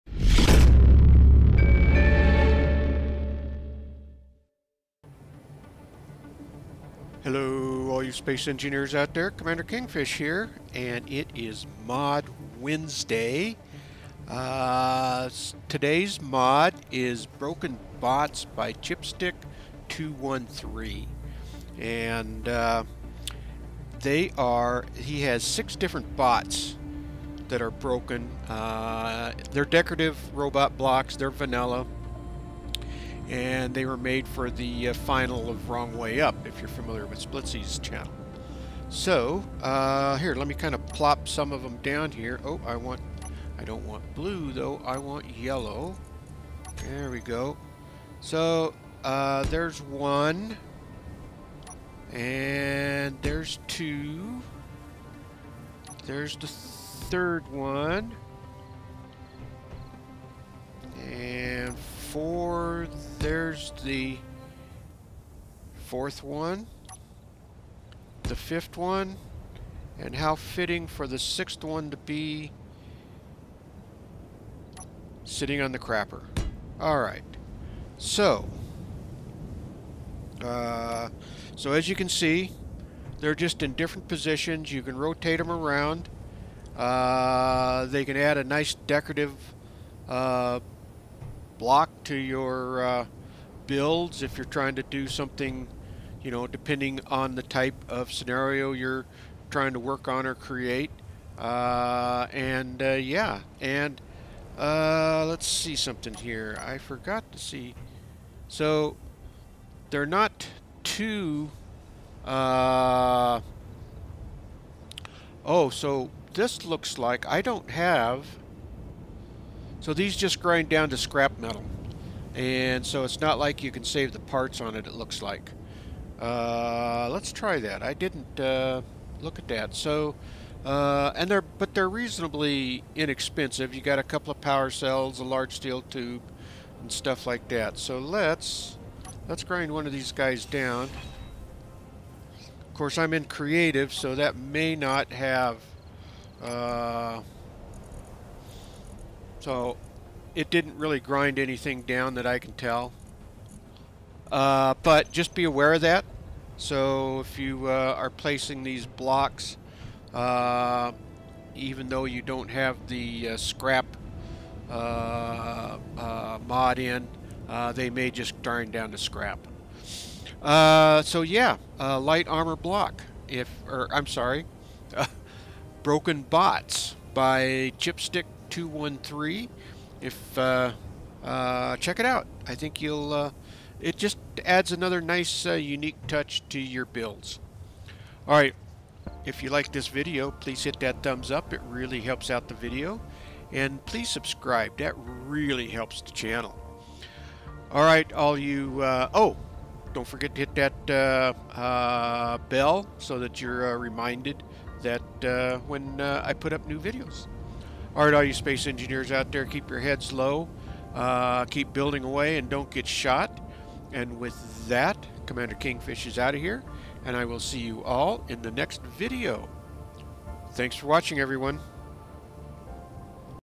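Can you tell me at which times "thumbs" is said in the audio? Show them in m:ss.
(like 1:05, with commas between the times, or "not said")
3:11.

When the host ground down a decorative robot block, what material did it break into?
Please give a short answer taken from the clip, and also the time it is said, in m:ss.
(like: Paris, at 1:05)
Scrap metal, at 2:00.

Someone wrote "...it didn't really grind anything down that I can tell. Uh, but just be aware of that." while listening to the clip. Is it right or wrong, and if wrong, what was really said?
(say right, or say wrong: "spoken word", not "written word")
right.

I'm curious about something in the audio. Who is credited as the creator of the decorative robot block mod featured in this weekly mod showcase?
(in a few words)
Chipstix213.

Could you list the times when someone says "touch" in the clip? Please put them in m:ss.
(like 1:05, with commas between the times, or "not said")
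3:06.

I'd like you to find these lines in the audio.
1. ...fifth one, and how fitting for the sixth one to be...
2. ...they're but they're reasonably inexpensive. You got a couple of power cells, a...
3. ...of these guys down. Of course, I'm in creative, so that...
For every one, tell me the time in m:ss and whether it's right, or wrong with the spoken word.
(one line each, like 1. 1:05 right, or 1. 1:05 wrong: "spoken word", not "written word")
1. 1:08 right
2. 2:11 right
3. 2:19 right.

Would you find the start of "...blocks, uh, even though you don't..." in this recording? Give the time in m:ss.
2:38.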